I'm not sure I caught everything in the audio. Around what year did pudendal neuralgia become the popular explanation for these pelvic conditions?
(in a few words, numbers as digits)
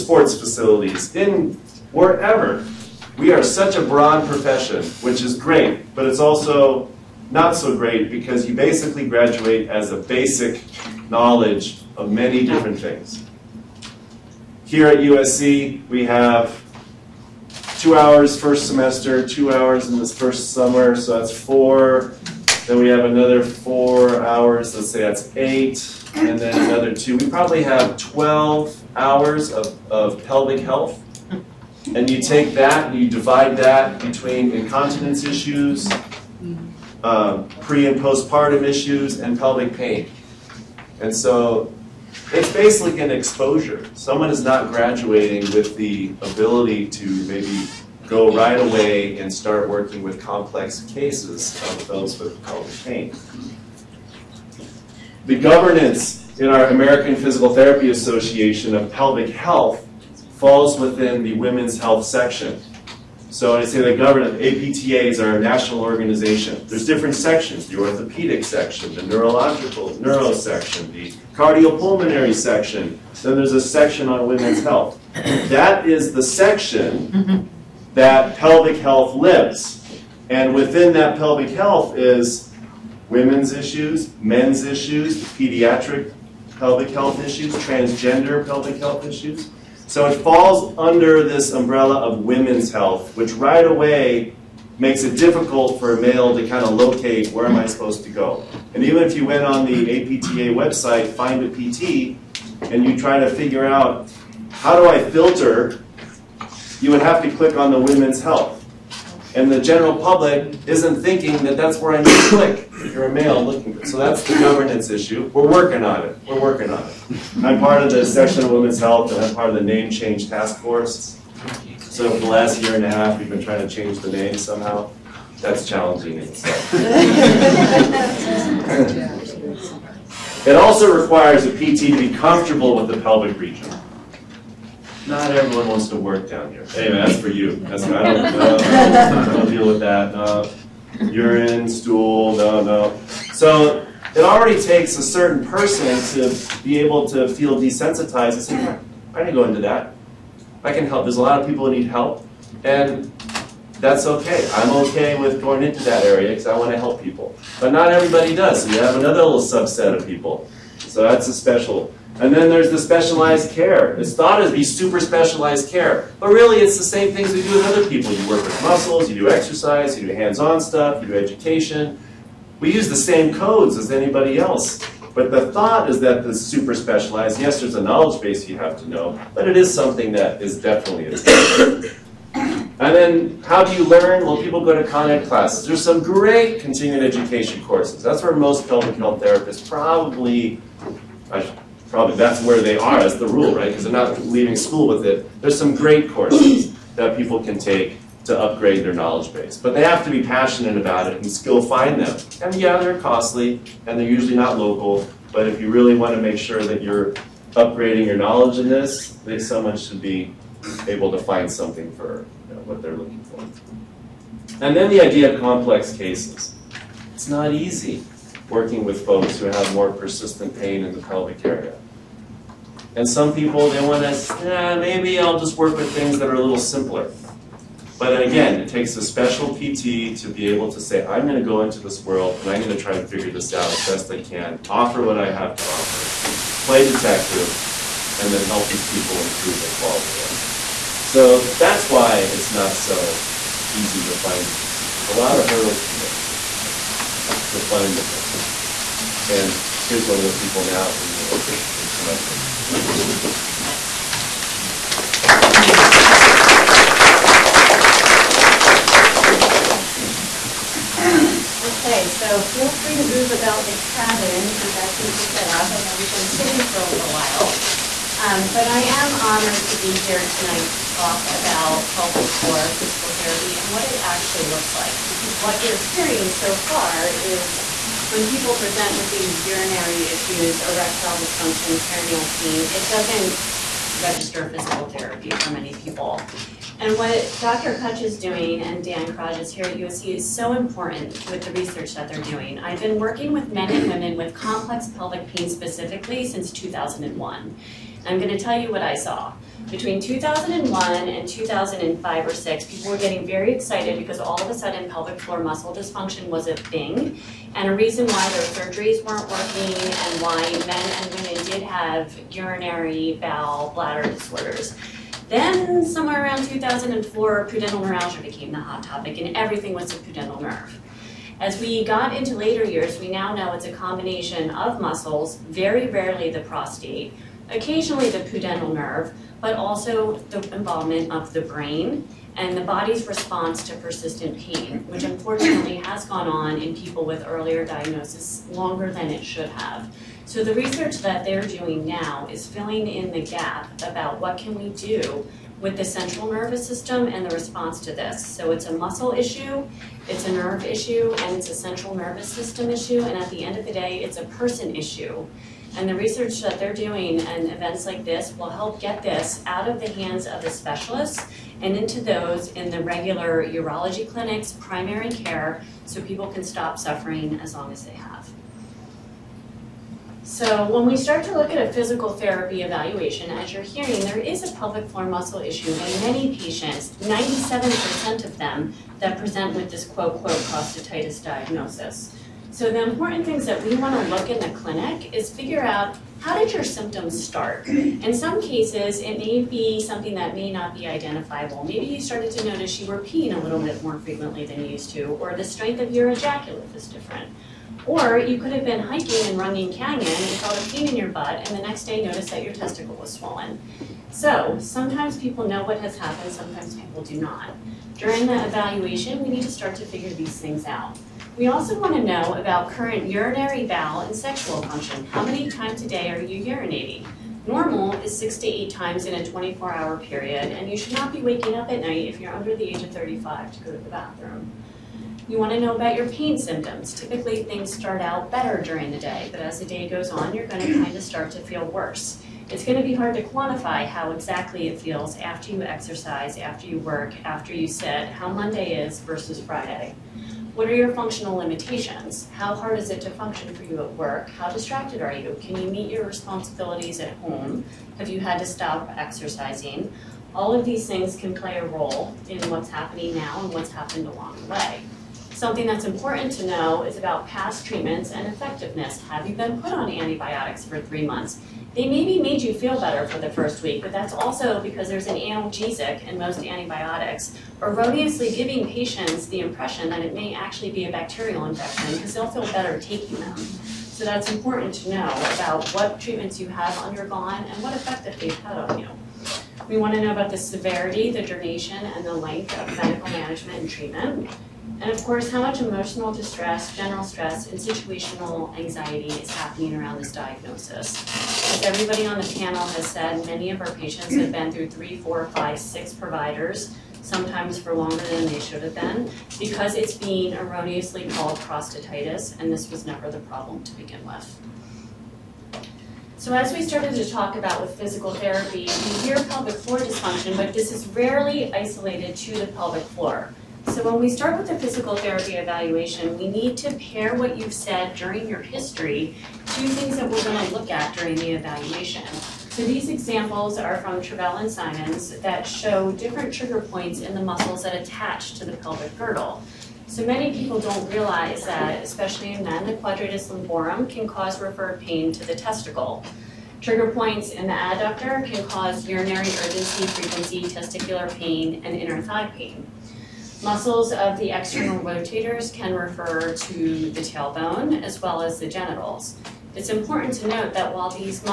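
2004.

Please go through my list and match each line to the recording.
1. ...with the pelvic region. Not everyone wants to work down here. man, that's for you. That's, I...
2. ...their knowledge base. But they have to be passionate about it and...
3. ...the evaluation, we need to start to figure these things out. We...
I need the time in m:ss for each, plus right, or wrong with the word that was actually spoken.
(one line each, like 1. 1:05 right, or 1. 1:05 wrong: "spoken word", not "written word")
1. 2:12 right
2. 3:18 right
3. 6:48 right.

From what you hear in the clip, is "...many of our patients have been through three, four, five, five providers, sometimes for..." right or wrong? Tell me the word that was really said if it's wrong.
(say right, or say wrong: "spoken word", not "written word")
wrong: "six", not "five".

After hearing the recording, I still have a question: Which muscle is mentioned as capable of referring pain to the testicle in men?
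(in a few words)
Quadratus lumborum.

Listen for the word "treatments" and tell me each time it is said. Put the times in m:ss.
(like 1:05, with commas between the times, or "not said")
7:37, 7:56, 8:03.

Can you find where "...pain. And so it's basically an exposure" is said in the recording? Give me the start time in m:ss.
0:39.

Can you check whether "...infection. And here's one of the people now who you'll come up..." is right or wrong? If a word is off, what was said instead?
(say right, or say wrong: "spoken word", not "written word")
wrong: "person", not "infection".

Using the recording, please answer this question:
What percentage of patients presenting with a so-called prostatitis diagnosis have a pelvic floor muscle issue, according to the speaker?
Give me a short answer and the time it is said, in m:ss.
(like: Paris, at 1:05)
97%, at 6:17.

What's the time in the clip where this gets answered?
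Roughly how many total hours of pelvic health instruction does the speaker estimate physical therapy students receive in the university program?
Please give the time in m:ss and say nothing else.
0:27.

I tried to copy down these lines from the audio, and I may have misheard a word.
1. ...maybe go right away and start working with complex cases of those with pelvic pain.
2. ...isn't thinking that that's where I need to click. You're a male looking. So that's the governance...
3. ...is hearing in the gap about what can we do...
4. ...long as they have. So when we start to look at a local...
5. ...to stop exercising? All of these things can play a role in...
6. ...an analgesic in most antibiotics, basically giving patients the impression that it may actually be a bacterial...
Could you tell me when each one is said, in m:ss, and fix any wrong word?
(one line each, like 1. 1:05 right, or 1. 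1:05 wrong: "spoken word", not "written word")
1. 0:47 right
2. 1:50 right
3. 5:42 wrong: "filling", not "hearing"
4. 6:07 wrong: "physical", not "local"
5. 7:28 right
6. 7:45 wrong: "erroneously", not "basically".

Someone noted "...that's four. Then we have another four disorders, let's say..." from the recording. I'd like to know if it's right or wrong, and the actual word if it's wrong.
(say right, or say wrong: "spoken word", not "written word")
wrong: "hours", not "disorders".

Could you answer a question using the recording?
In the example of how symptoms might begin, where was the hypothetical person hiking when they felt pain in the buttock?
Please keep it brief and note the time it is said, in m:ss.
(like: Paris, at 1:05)
Runyon Canyon, at 6:39.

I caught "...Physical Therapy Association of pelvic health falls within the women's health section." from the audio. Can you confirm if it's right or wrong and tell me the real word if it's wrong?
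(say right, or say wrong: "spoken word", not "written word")
right.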